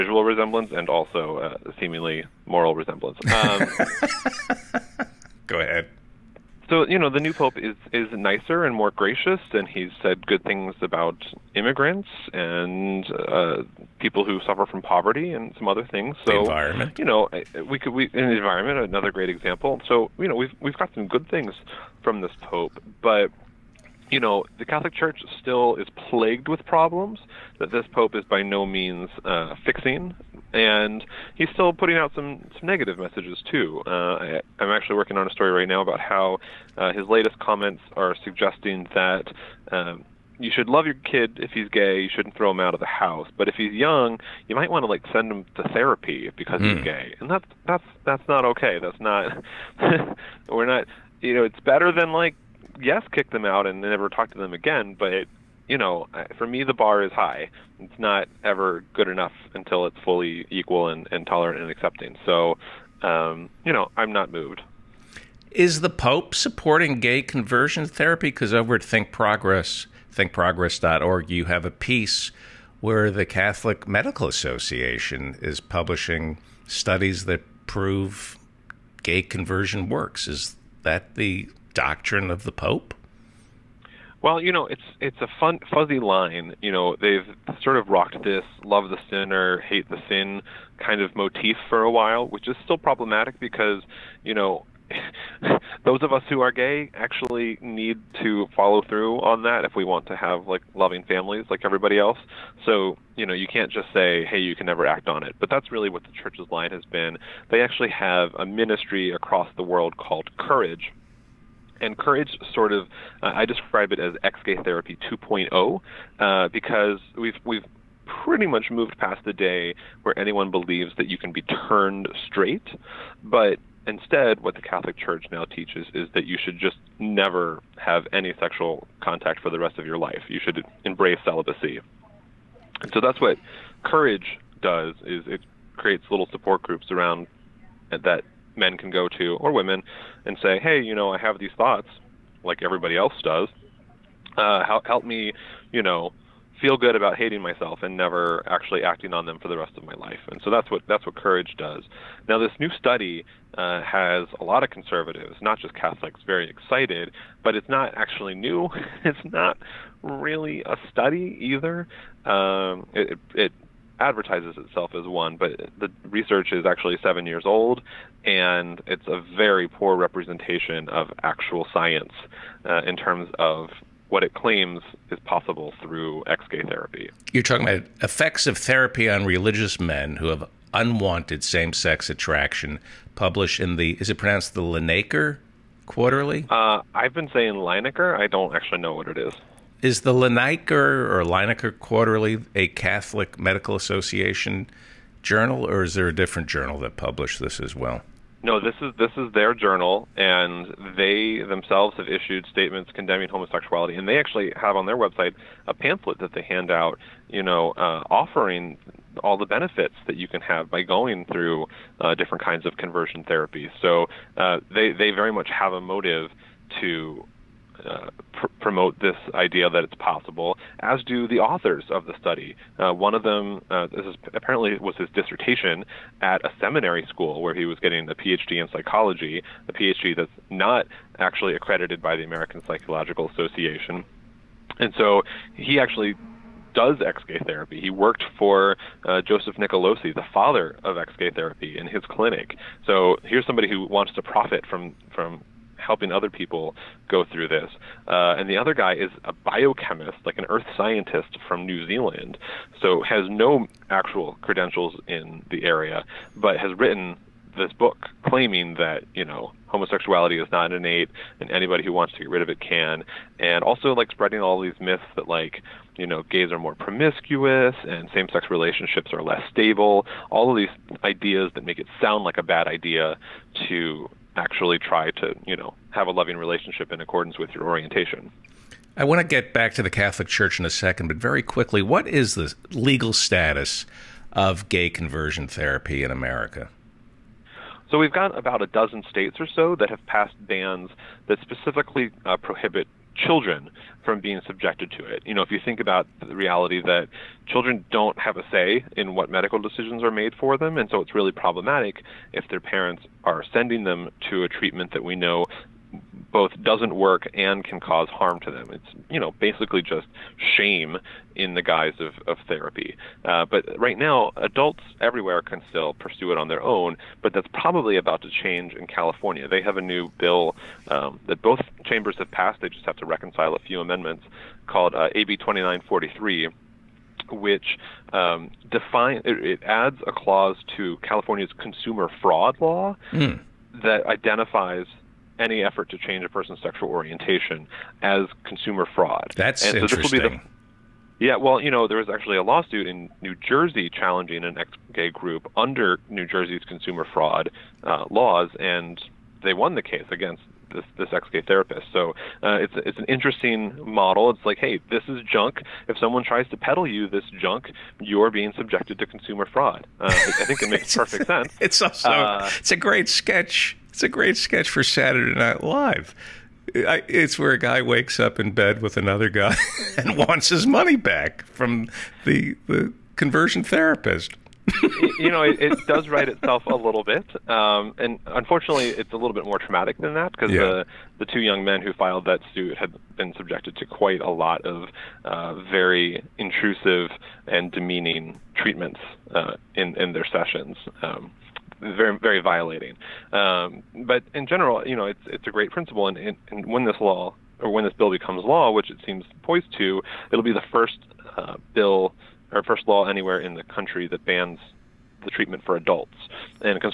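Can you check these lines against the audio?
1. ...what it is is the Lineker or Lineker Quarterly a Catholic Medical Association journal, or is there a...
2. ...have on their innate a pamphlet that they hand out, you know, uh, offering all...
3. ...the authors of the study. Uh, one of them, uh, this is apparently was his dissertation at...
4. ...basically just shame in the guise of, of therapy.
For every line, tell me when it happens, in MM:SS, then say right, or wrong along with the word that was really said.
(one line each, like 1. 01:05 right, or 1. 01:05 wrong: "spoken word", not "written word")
1. 03:08 right
2. 03:24 wrong: "website", not "innate"
3. 03:41 right
4. 05:09 right.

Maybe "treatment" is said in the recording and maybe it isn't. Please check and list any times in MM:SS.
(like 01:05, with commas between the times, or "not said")
05:04, 06:28, 06:45.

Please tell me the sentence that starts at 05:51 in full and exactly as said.
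So uh, it's, it's an interesting model.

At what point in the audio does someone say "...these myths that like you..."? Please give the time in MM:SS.
04:24.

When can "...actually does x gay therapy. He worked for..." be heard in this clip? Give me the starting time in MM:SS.
03:55.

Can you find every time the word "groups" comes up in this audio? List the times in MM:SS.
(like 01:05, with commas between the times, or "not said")
02:16, 05:45.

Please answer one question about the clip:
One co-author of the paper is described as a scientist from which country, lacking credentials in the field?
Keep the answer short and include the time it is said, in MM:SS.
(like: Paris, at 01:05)
New Zealand, at 04:11.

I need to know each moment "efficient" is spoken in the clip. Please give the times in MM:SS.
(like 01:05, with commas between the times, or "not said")
not said.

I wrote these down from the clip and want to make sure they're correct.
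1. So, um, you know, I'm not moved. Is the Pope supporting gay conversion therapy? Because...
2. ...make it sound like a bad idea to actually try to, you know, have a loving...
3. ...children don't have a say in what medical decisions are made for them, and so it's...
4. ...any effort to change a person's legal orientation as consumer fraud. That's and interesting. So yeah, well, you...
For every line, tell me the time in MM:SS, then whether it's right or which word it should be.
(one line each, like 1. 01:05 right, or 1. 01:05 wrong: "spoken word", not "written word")
1. 01:02 right
2. 04:31 right
3. 04:57 right
4. 05:35 wrong: "sexual", not "legal".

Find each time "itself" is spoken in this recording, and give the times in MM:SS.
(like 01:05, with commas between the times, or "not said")
02:44, 06:16.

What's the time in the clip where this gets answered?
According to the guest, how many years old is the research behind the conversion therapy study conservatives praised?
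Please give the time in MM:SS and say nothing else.
02:45.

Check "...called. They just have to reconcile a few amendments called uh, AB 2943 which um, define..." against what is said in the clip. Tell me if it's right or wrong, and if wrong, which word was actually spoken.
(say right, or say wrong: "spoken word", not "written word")
wrong: "passed", not "called".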